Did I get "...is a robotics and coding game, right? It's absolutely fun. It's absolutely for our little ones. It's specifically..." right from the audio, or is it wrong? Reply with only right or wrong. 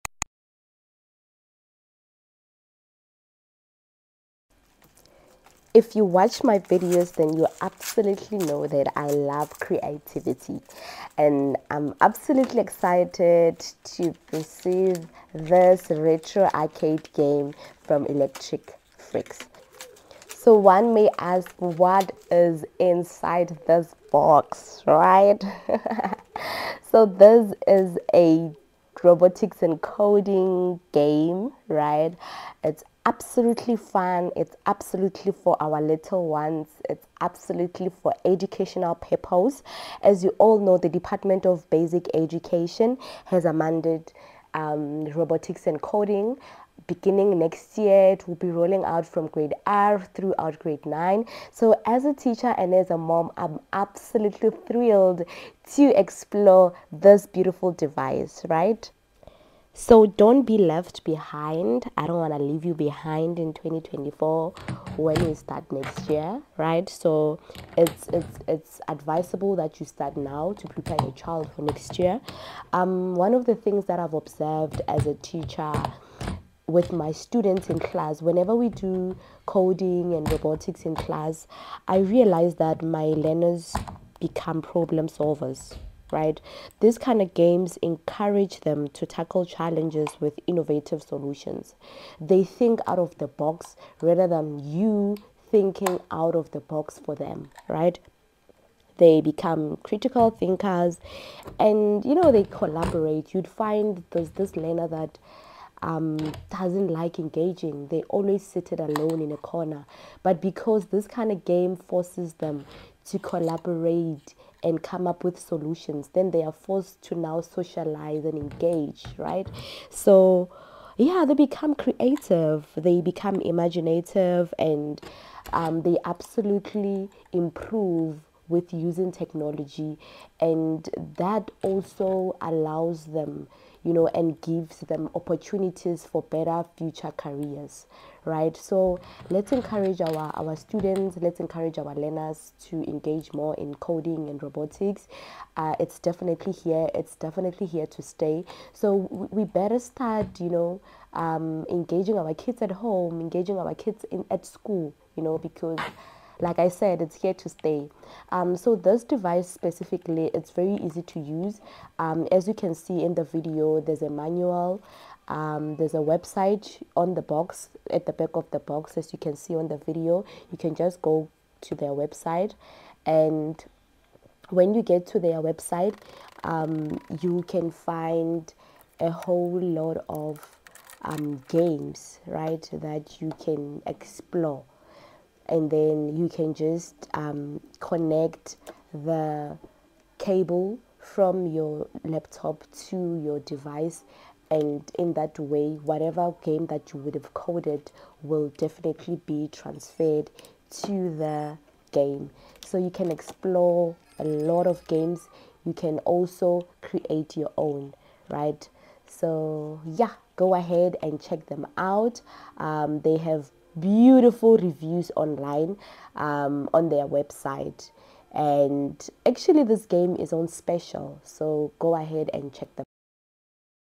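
wrong.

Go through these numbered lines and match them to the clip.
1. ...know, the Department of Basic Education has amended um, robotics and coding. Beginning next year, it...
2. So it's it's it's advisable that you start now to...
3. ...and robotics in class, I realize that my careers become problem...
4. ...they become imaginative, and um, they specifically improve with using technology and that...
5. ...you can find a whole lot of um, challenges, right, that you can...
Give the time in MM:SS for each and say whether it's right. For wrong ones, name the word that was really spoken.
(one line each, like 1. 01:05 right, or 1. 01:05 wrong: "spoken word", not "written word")
1. 00:40 right
2. 01:06 right
3. 01:20 wrong: "learners", not "careers"
4. 02:02 wrong: "absolutely", not "specifically"
5. 02:57 wrong: "games", not "challenges".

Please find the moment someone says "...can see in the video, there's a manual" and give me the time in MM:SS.
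02:42.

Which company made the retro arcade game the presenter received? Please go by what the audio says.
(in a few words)
Electric Freaks.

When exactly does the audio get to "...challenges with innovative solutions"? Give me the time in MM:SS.
01:29.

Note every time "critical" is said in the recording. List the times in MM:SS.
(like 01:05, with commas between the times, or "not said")
01:39.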